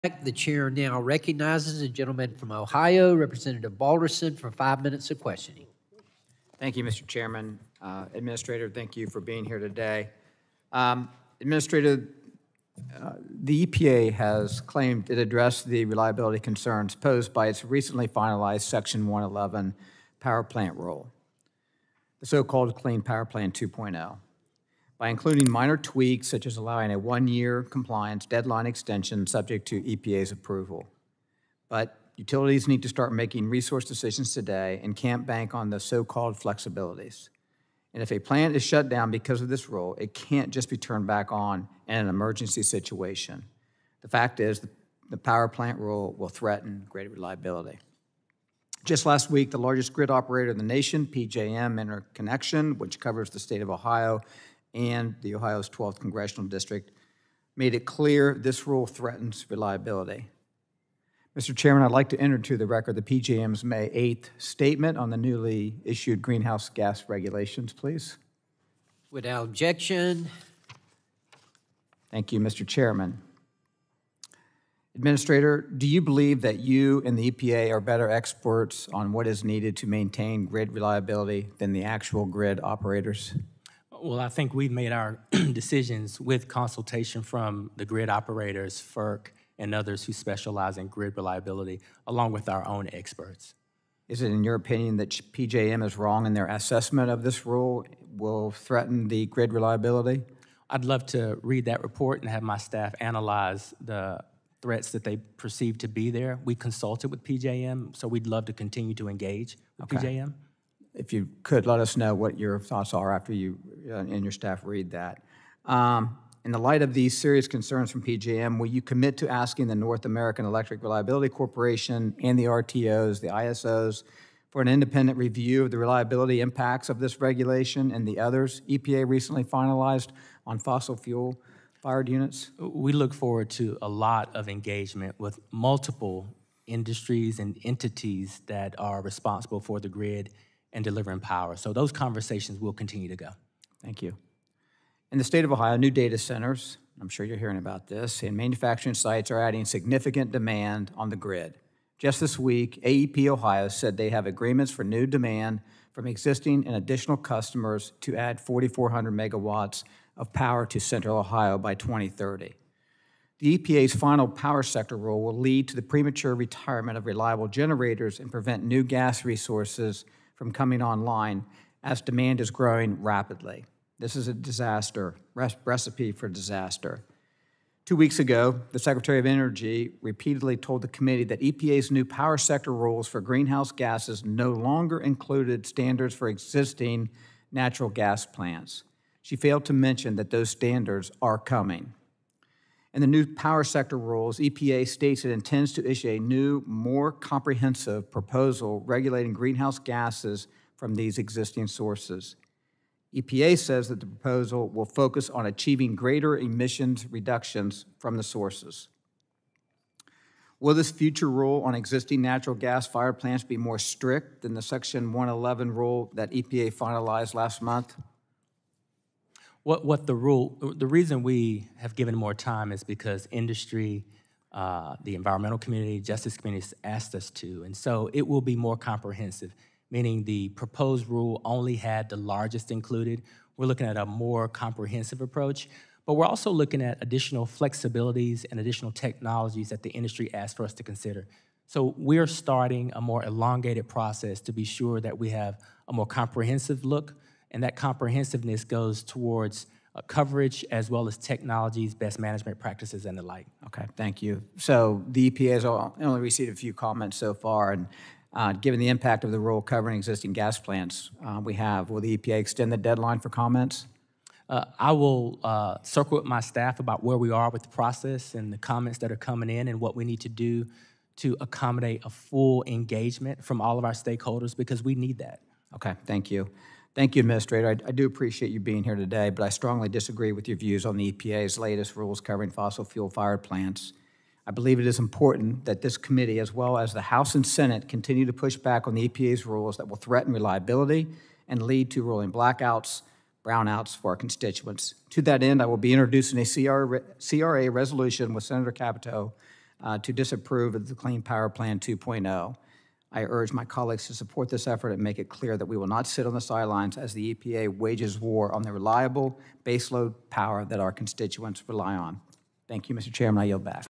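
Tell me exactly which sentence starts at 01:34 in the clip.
Is it in your opinion that PJM is wrong in their assessment of this rule will threaten the grid reliability?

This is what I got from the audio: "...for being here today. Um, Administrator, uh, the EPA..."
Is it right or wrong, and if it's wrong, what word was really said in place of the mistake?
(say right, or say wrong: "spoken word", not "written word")
right.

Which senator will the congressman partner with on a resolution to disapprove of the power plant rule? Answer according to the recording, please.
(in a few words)
Senator Capito.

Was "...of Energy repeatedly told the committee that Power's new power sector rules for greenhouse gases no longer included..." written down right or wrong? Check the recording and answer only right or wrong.
wrong.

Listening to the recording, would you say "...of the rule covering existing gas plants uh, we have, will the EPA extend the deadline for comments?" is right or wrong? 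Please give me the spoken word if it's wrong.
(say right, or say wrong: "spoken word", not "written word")
right.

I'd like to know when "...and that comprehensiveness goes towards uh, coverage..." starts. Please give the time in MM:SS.
04:07.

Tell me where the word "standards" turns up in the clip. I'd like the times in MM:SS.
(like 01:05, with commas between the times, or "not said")
03:05, 03:10.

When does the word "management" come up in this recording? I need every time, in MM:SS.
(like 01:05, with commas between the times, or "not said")
04:12.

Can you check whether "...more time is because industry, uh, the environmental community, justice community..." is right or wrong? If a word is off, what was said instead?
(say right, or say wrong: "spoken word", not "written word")
right.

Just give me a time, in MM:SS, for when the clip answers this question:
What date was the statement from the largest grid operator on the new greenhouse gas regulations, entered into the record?
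01:03.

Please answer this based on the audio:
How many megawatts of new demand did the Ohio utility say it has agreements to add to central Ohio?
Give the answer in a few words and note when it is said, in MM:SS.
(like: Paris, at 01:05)
4,400, at 02:38.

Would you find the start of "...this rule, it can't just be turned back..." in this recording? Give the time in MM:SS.
00:39.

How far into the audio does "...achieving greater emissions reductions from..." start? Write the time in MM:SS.
03:25.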